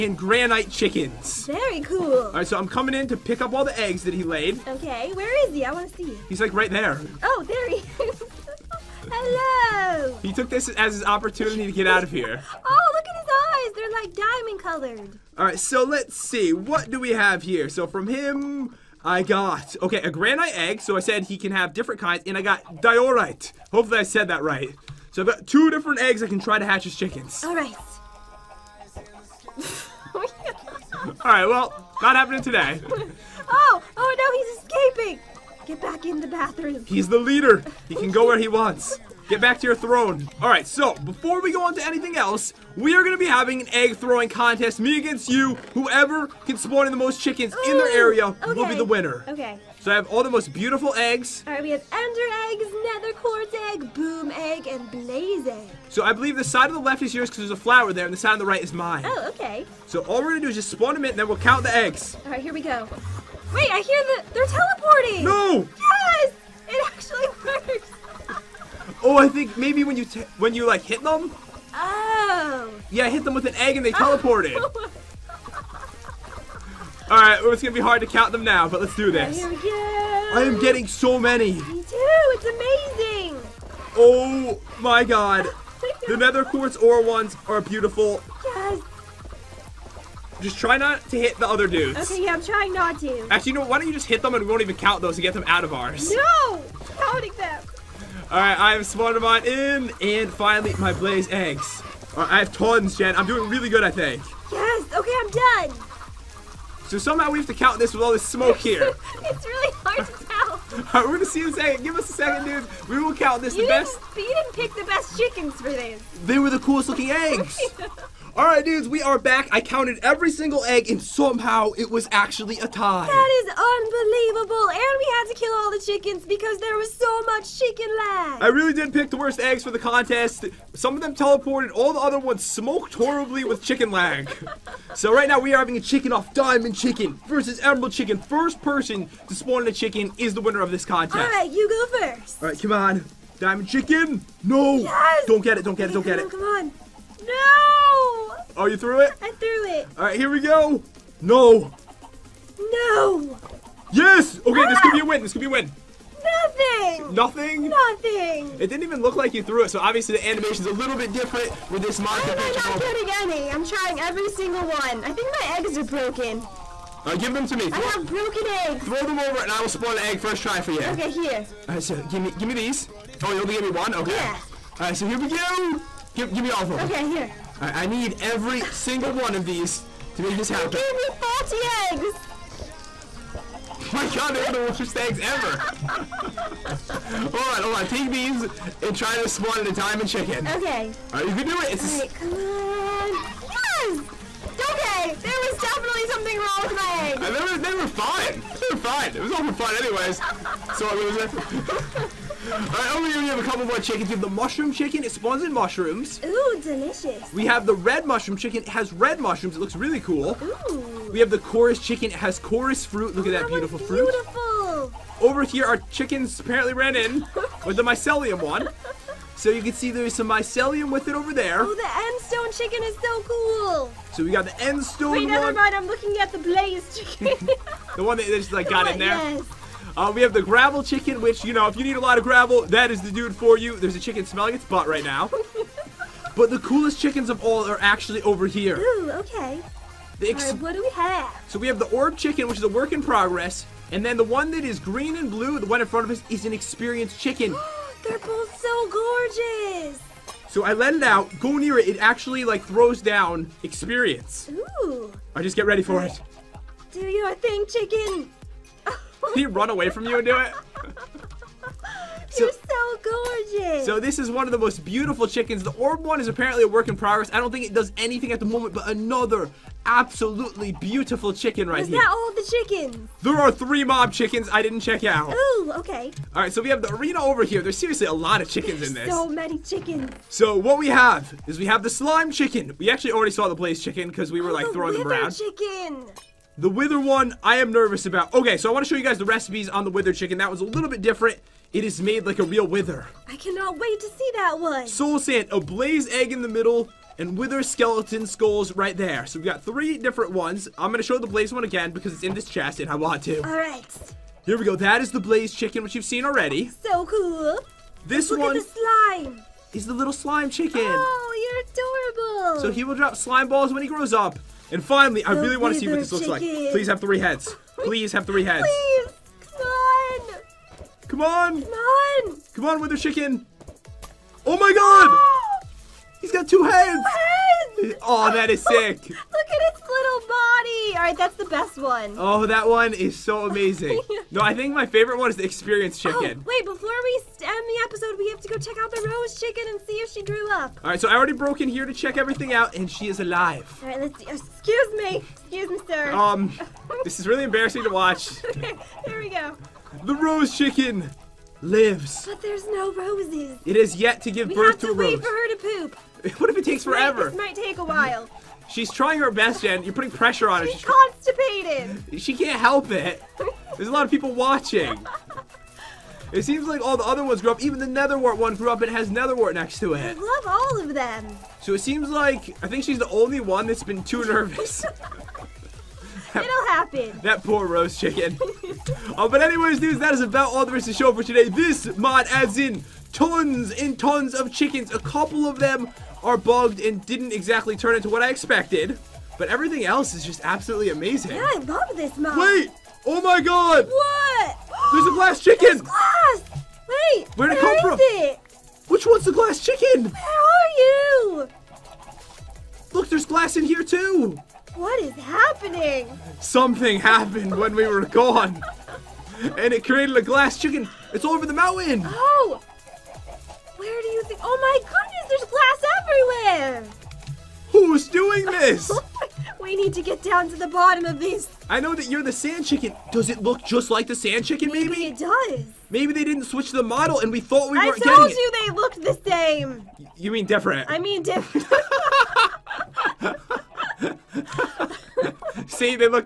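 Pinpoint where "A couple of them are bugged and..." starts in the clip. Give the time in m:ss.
6:24.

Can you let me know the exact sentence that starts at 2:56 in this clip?
Give, give me all of them.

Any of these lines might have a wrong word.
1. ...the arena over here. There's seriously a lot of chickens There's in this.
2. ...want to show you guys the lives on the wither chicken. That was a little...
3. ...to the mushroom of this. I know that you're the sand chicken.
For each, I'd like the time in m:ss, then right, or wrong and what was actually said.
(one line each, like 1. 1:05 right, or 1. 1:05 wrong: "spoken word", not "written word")
1. 4:36 right
2. 4:48 wrong: "recipes", not "lives"
3. 7:00 wrong: "bottom", not "mushroom".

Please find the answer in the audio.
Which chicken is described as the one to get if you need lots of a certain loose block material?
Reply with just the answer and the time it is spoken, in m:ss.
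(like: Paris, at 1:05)
Gravel chicken, at 3:50.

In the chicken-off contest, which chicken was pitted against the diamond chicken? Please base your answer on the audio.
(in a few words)
Emerald chicken.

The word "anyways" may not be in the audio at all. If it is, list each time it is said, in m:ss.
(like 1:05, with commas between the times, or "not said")
3:19, 6:19.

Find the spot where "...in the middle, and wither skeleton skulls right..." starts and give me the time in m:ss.
4:56.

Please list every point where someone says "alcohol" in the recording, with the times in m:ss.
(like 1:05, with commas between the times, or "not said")
not said.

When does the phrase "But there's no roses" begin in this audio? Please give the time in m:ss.
5:52.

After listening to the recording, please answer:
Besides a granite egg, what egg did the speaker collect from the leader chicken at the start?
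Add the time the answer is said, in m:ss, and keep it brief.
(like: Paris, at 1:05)
Diorite, at 0:22.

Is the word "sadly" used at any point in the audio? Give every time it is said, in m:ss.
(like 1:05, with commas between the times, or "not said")
not said.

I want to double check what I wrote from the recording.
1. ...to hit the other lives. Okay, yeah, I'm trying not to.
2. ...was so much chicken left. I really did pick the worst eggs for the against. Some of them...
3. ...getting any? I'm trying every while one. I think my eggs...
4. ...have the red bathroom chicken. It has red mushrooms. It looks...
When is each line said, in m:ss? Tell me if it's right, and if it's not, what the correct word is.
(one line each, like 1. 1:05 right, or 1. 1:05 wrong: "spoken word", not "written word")
1. 1:31 wrong: "dudes", not "lives"
2. 2:06 wrong: "contest", not "against"
3. 2:43 wrong: "single", not "while"
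4. 3:27 wrong: "mushroom", not "bathroom".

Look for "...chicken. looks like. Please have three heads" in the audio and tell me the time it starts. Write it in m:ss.
5:16.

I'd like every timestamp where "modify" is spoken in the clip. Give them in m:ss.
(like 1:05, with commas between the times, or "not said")
not said.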